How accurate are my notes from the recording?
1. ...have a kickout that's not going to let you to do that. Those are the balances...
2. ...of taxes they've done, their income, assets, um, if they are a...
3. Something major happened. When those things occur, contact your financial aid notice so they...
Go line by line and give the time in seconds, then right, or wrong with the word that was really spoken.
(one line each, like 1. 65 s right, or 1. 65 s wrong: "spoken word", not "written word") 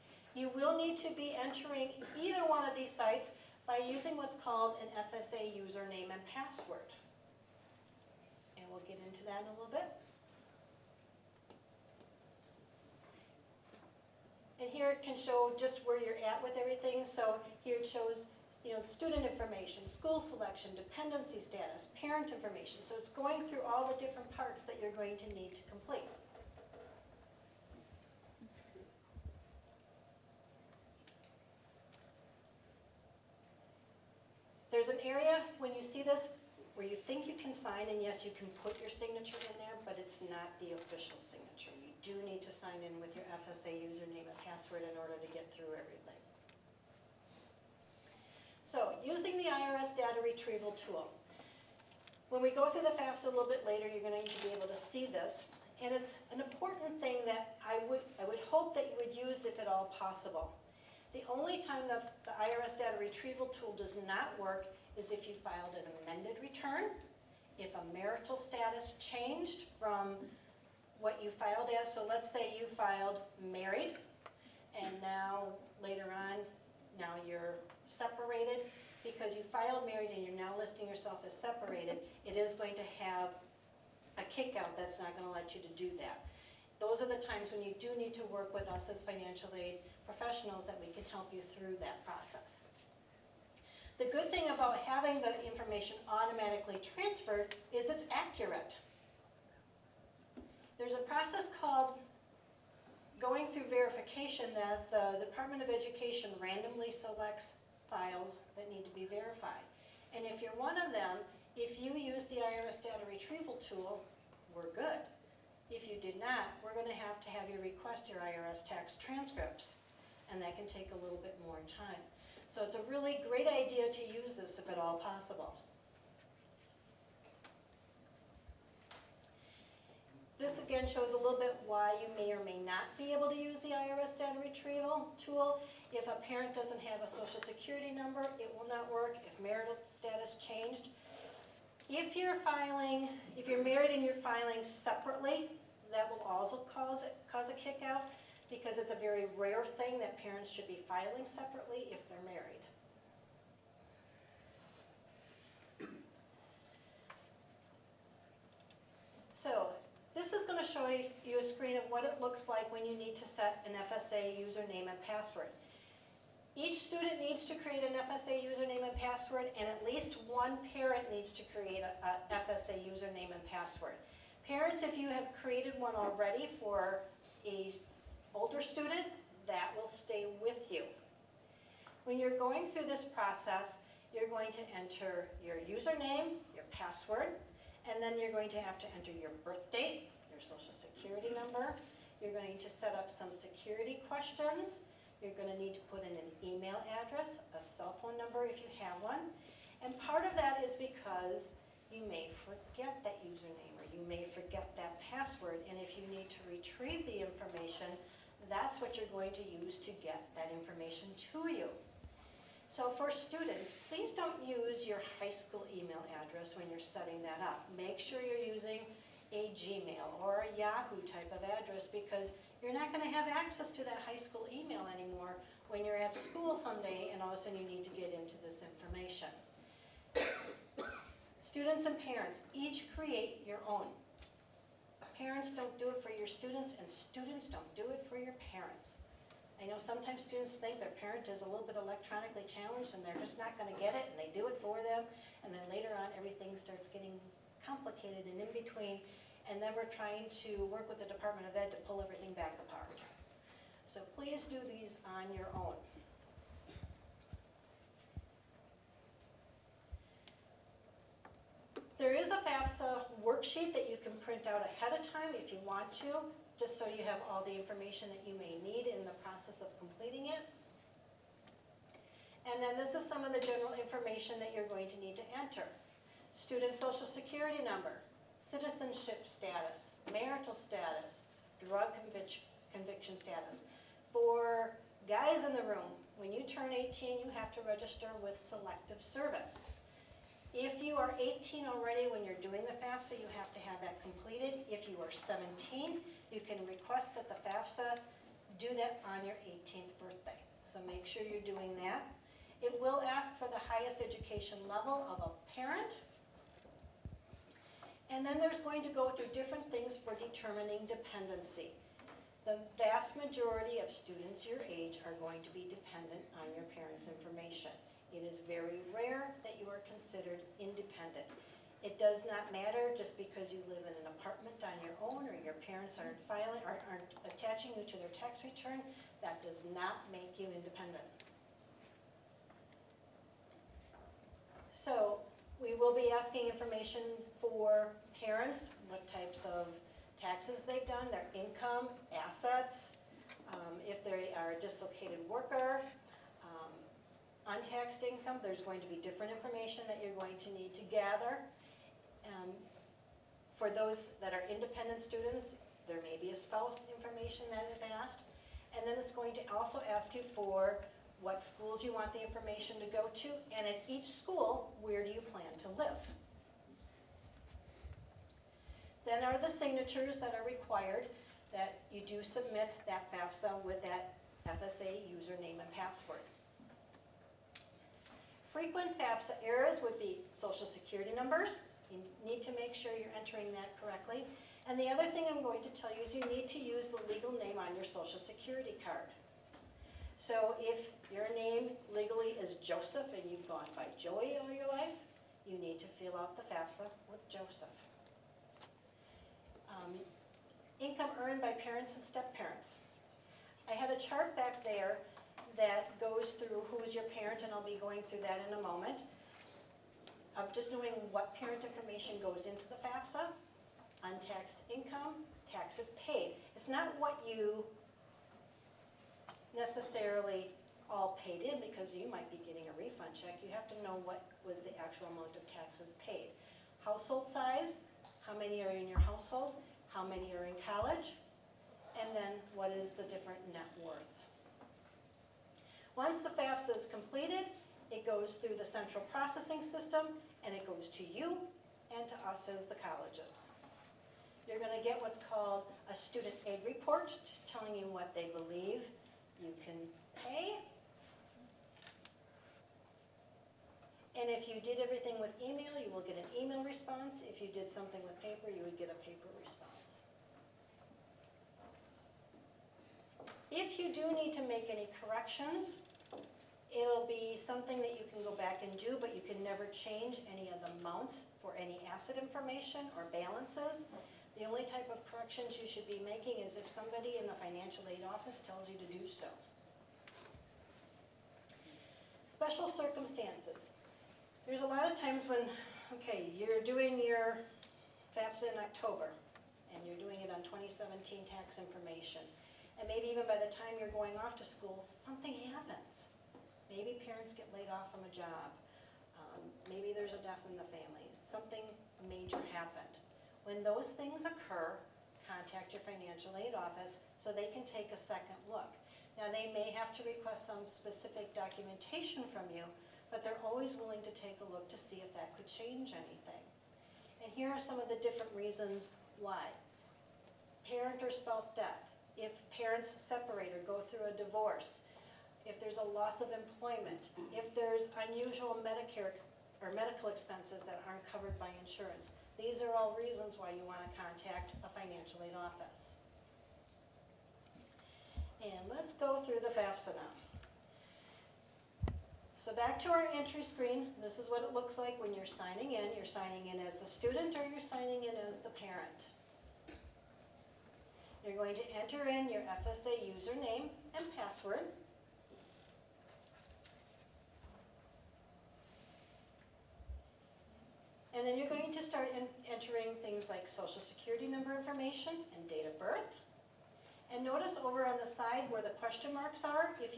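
1. 82 s wrong: "times", not "balances"
2. 339 s right
3. 501 s wrong: "office", not "notice".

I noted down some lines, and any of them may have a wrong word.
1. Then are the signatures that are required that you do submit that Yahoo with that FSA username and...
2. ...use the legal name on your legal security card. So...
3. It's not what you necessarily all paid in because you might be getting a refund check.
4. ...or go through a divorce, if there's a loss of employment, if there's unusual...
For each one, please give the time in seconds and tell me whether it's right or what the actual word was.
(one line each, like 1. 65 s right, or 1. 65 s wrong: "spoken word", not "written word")
1. 369 s wrong: "FAFSA", not "Yahoo"
2. 386 s wrong: "social", not "legal"
3. 416 s right
4. 523 s right.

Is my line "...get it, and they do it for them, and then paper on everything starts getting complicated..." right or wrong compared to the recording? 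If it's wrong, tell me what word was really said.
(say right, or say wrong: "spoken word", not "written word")
wrong: "later", not "paper".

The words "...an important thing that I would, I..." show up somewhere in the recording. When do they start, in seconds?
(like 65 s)
56 s.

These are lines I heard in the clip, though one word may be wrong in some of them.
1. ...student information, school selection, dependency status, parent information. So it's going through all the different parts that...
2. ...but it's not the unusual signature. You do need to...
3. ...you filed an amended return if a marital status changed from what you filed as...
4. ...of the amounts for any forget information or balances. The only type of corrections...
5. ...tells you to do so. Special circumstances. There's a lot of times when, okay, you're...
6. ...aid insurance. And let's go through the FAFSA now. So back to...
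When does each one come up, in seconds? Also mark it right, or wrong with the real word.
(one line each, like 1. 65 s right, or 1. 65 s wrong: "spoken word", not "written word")
1. 18 s right
2. 39 s wrong: "official", not "unusual"
3. 65 s right
4. 470 s wrong: "asset", not "forget"
5. 478 s right
6. 535 s wrong: "office", not "insurance".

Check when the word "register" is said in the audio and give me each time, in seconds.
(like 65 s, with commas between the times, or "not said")
287 s.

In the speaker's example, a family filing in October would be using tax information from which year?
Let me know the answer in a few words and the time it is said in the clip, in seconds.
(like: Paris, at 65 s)
2017, at 490 s.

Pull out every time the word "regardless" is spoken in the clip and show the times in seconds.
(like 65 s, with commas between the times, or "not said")
not said.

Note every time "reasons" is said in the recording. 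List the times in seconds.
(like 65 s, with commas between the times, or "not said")
518 s, 532 s.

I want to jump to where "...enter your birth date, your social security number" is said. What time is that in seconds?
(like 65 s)
188 s.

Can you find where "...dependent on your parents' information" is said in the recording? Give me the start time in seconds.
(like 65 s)
315 s.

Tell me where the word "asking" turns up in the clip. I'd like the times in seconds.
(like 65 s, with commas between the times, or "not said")
336 s.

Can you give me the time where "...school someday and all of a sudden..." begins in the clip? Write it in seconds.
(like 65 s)
226 s.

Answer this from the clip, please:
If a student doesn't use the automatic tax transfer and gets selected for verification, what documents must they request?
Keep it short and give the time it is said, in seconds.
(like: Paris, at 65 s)
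IRS tax transcripts, at 118 s.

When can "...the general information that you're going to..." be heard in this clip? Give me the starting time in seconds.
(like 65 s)
273 s.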